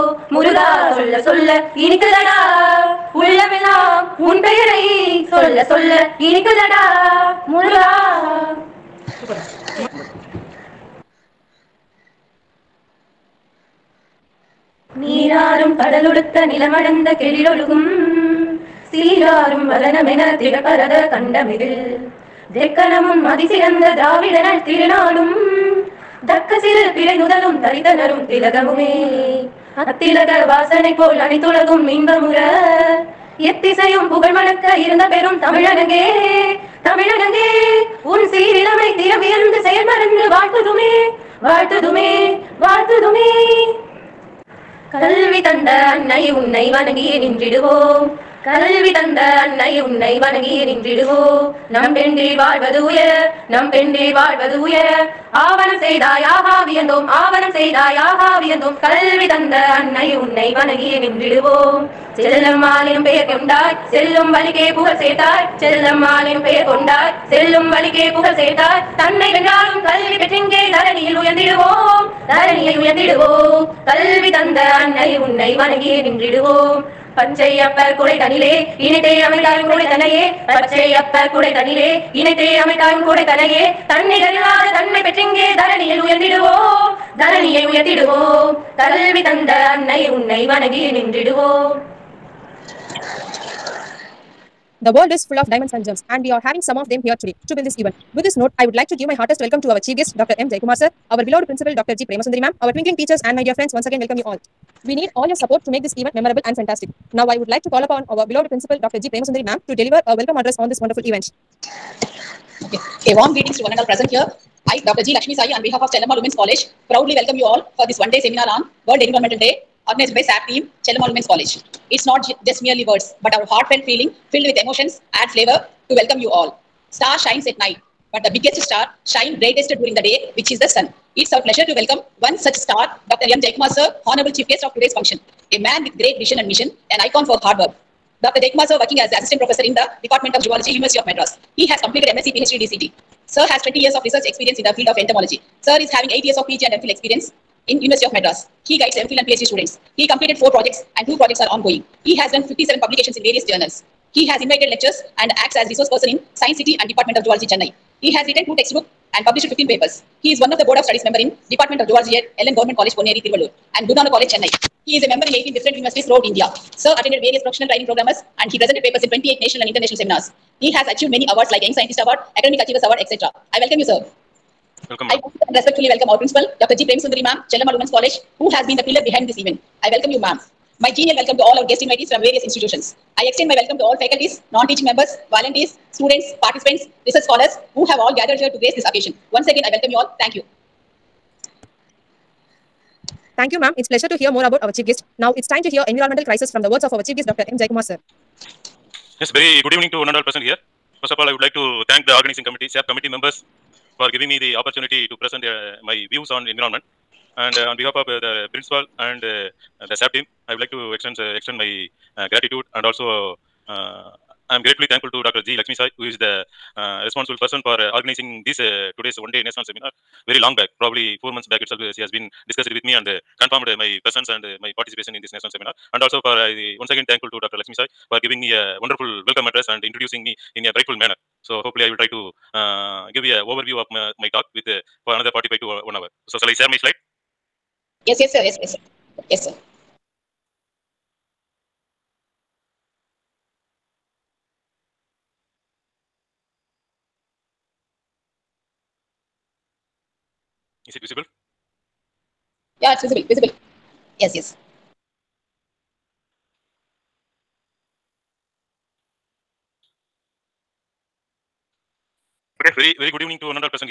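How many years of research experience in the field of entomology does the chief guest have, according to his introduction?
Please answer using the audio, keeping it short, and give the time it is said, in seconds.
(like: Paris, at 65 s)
20, at 143 s.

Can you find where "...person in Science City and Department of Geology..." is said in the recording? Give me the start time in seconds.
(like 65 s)
155 s.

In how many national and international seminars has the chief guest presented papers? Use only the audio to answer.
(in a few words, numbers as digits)
28.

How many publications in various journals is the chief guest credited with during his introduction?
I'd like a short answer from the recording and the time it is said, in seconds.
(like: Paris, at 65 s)
57, at 152 s.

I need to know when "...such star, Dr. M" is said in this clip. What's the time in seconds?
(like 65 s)
132 s.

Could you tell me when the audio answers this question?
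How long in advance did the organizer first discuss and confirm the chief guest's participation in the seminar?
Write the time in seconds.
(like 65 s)
221 s.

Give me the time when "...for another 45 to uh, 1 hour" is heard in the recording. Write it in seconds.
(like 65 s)
235 s.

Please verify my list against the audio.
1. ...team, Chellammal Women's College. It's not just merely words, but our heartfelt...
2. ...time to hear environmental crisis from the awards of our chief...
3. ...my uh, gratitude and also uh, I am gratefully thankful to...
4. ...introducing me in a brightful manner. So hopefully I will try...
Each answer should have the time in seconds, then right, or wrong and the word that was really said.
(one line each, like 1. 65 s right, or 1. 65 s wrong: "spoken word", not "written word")
1. 120 s right
2. 195 s wrong: "words", not "awards"
3. 211 s right
4. 229 s right.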